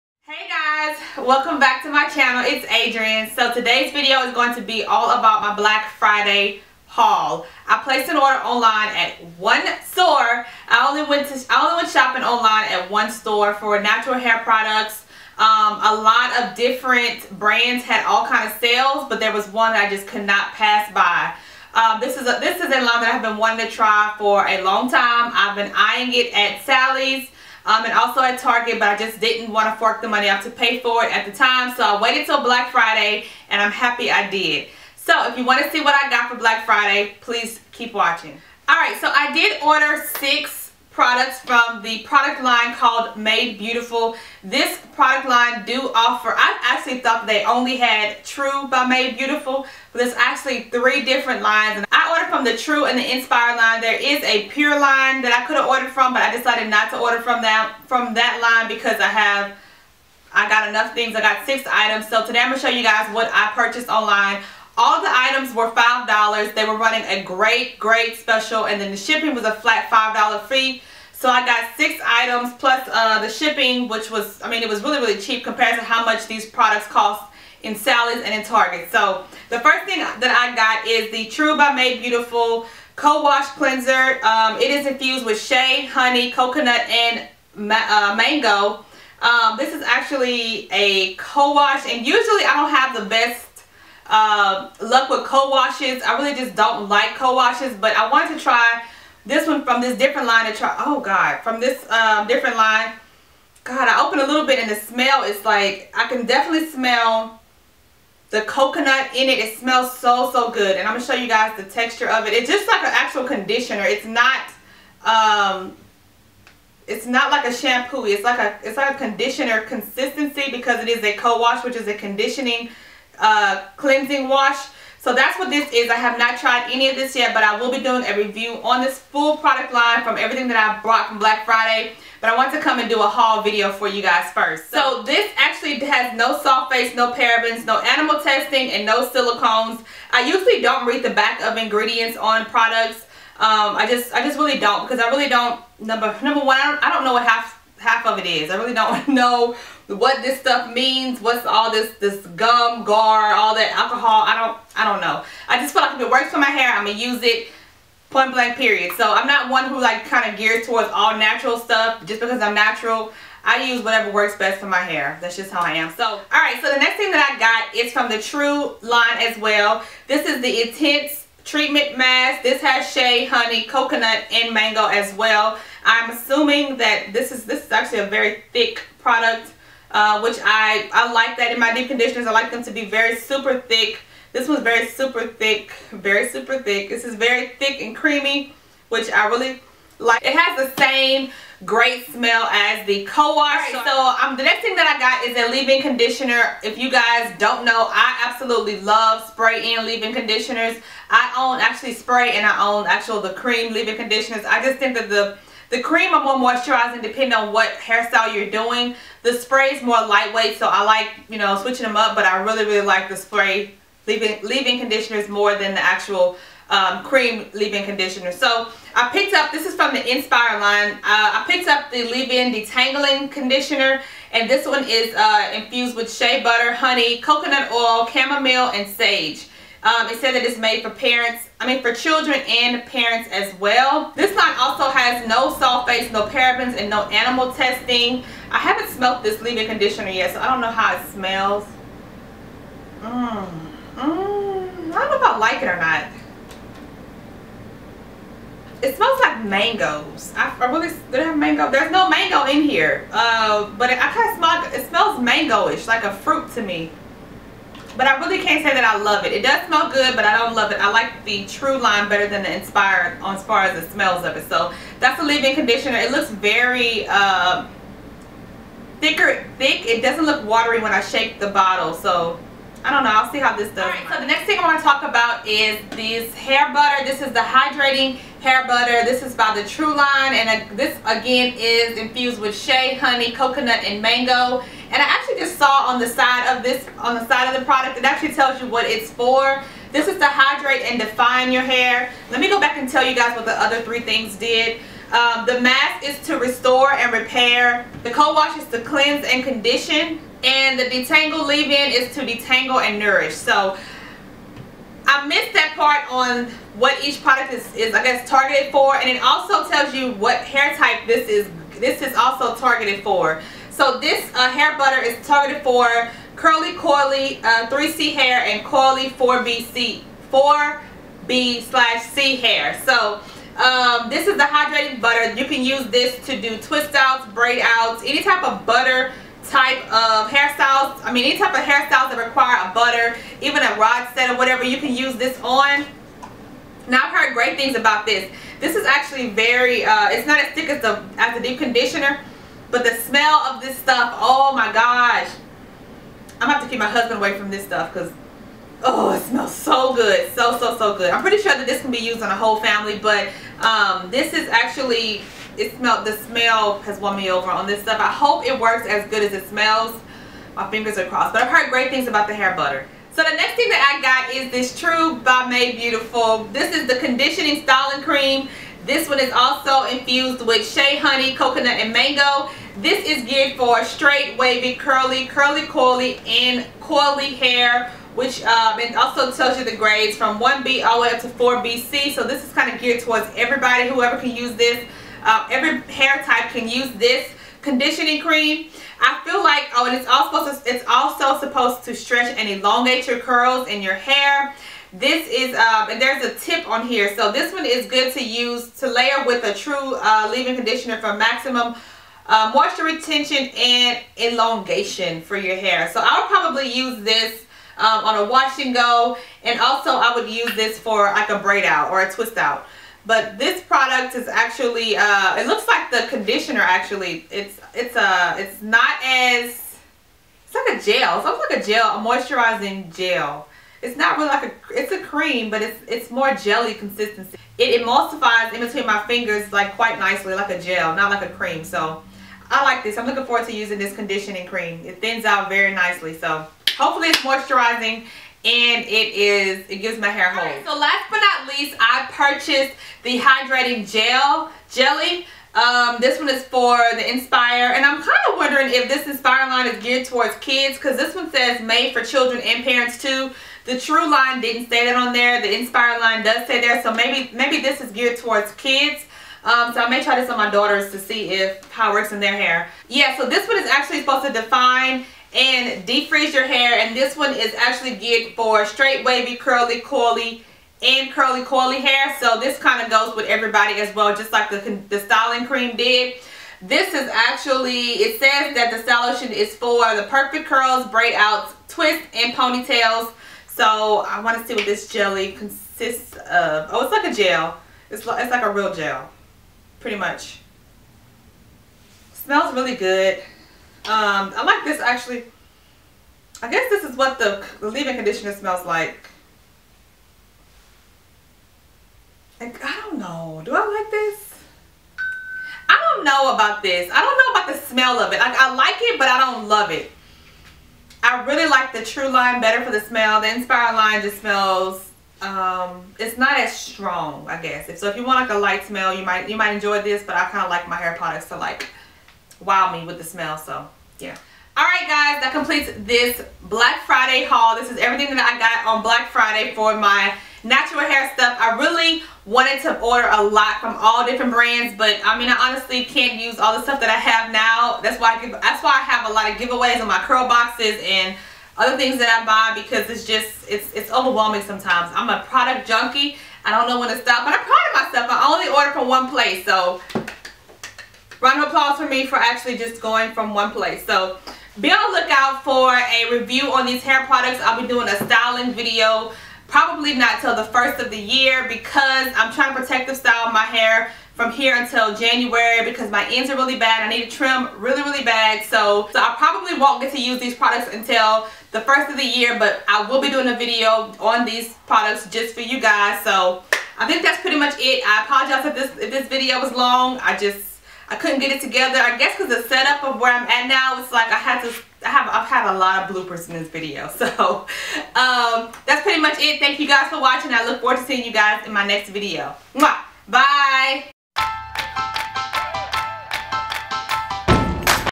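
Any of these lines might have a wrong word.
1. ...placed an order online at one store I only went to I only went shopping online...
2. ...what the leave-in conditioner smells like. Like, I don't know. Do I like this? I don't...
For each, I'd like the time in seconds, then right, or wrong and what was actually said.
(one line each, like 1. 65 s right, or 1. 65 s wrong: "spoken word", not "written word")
1. 7 s right
2. 496 s right.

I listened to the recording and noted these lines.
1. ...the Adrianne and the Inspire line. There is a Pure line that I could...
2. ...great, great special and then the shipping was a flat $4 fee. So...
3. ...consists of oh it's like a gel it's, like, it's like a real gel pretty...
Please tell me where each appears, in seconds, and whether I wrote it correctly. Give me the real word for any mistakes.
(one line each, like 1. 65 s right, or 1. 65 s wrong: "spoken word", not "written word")
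1. 52 s wrong: "True", not "Adrianne"
2. 67 s wrong: "5", not "4"
3. 485 s right.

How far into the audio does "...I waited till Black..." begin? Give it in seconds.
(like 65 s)
31 s.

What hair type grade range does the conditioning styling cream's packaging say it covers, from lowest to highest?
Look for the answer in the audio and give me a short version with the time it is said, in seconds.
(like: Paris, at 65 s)
1B to 4BC, at 380 s.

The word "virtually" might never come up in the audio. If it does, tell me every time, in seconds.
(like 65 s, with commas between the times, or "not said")
not said.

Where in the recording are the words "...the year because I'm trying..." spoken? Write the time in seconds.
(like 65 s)
560 s.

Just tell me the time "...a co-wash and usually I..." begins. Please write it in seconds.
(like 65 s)
90 s.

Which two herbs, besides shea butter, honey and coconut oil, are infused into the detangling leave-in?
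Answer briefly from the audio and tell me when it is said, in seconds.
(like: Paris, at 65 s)
chamomile and sage, at 228 s.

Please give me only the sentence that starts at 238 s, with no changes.
I haven't smelled this leave-in conditioner yet, so I don't know how it smells.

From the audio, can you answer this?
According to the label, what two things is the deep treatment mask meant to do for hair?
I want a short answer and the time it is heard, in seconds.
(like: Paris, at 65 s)
restore and repair, at 296 s.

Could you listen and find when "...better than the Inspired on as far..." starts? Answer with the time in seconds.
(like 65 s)
262 s.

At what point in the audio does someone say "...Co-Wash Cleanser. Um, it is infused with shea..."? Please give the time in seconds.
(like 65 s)
82 s.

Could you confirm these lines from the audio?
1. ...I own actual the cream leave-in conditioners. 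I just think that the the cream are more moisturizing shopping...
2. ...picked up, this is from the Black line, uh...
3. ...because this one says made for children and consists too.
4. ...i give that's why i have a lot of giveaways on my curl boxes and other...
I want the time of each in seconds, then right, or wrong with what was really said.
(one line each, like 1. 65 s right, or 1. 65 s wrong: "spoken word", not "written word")
1. 202 s wrong: "depending", not "shopping"
2. 219 s wrong: "Inspire", not "Black"
3. 450 s wrong: "parents", not "consists"
4. 538 s right.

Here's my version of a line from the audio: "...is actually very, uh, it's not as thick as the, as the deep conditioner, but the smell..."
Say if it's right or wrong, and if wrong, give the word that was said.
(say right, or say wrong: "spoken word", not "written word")
right.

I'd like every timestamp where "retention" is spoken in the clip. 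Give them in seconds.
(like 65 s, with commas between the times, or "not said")
402 s.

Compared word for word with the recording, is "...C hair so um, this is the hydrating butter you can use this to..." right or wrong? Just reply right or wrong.
right.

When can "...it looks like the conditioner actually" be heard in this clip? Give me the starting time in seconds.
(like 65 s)
415 s.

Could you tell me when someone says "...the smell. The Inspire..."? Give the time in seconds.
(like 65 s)
512 s.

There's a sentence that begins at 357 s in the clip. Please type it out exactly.
I hope it works as good as it smells.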